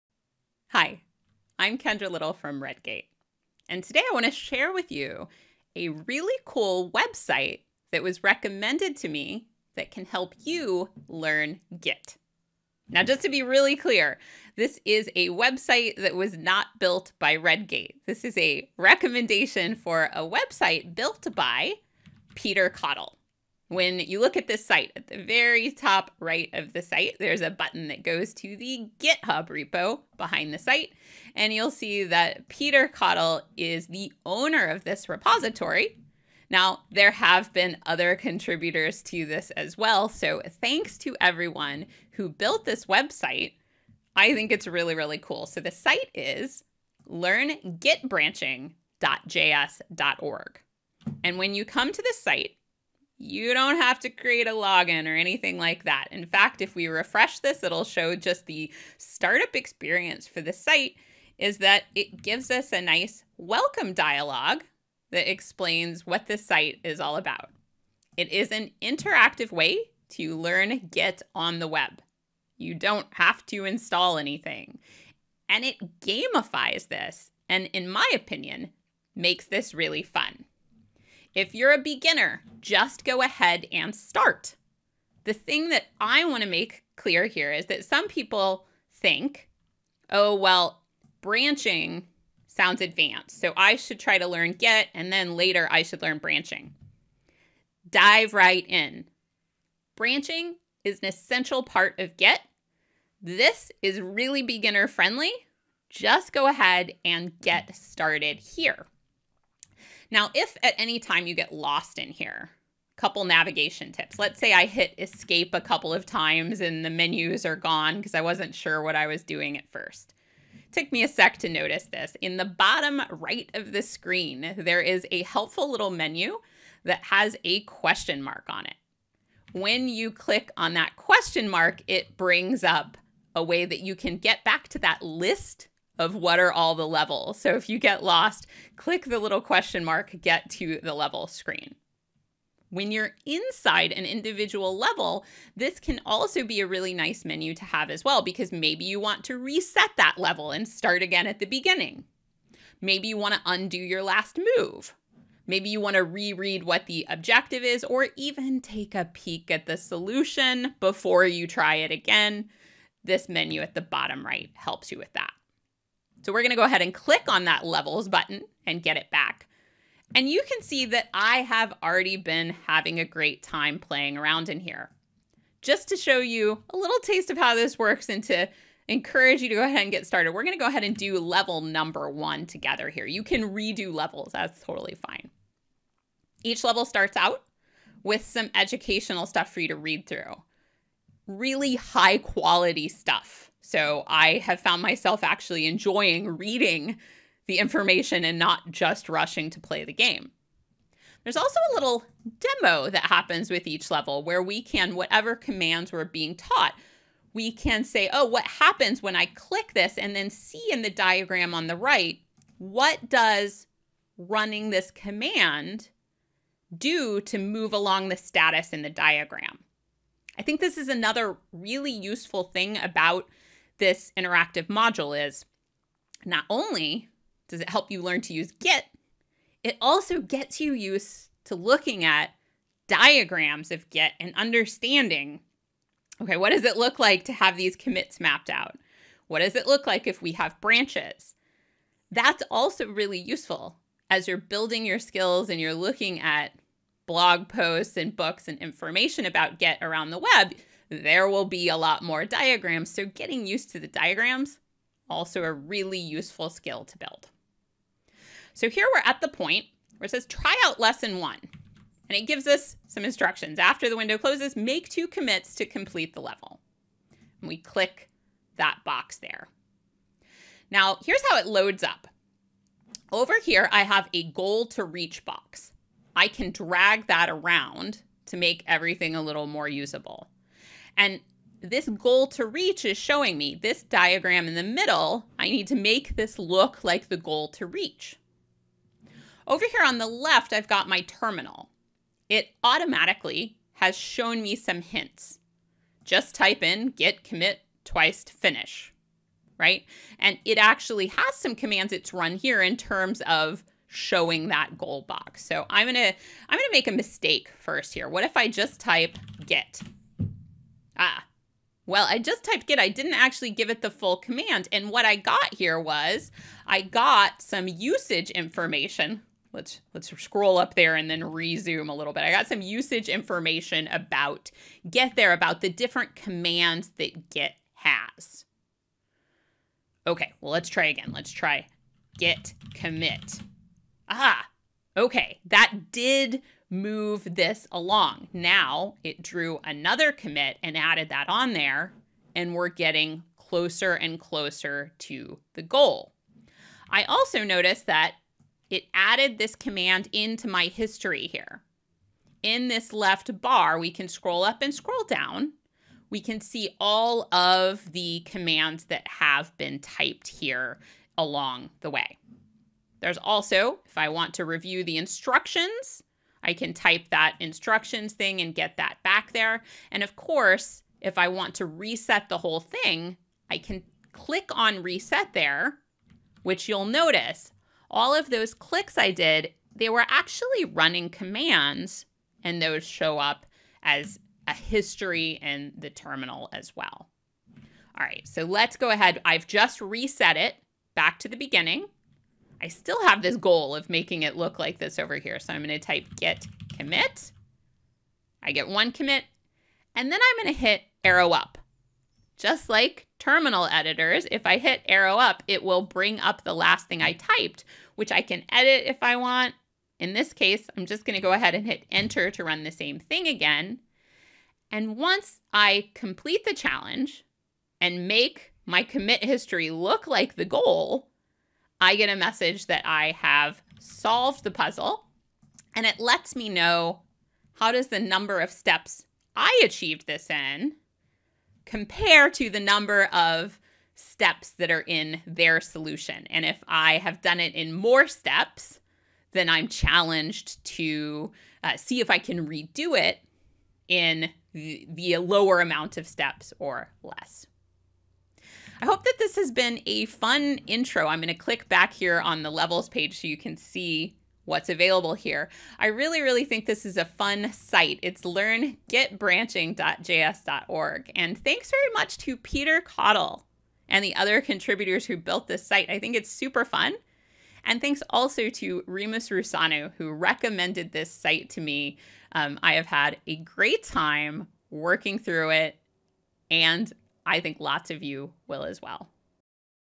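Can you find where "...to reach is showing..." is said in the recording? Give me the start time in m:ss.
4:42.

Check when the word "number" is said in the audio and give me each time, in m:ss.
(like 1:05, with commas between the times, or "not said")
3:01, 7:07, 7:12.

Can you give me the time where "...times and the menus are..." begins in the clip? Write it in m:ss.
1:56.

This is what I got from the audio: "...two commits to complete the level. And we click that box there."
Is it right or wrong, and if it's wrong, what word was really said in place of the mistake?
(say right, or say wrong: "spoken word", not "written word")
right.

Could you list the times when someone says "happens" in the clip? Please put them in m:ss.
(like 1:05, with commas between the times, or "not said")
3:23, 3:28.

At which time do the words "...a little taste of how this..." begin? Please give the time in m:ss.
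2:56.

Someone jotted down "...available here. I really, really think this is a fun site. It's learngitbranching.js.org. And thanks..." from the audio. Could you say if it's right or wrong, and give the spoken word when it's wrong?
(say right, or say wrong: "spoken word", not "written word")
right.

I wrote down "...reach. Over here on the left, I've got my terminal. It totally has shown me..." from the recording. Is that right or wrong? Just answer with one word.
wrong.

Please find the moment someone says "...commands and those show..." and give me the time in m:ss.
6:21.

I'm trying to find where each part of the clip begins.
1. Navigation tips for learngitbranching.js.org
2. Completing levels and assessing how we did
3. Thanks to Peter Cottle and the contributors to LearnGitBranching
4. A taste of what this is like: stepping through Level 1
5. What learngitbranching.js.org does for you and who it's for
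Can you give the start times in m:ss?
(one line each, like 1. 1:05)
1. 1:50
2. 7:10
3. 7:40
4. 3:00
5. 0:52.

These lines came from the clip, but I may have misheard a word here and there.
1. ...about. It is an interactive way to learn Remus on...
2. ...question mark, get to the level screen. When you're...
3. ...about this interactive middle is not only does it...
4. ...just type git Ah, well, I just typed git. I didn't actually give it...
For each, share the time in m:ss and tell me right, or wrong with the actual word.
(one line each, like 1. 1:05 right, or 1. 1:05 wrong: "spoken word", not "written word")
1. 1:07 wrong: "Git", not "Remus"
2. 2:19 right
3. 3:42 wrong: "module", not "middle"
4. 5:08 right.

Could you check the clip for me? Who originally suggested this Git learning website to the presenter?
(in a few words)
Remus Rusanu.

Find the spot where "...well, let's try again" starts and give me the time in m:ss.
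5:30.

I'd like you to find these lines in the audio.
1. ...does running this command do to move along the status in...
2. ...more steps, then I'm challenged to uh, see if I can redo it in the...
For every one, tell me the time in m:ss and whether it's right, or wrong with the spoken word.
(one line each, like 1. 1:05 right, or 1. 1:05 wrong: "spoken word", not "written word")
1. 3:33 right
2. 7:17 right.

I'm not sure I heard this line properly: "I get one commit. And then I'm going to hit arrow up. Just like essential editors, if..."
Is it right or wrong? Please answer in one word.
wrong.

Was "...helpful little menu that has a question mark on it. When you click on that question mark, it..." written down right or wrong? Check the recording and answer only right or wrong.
right.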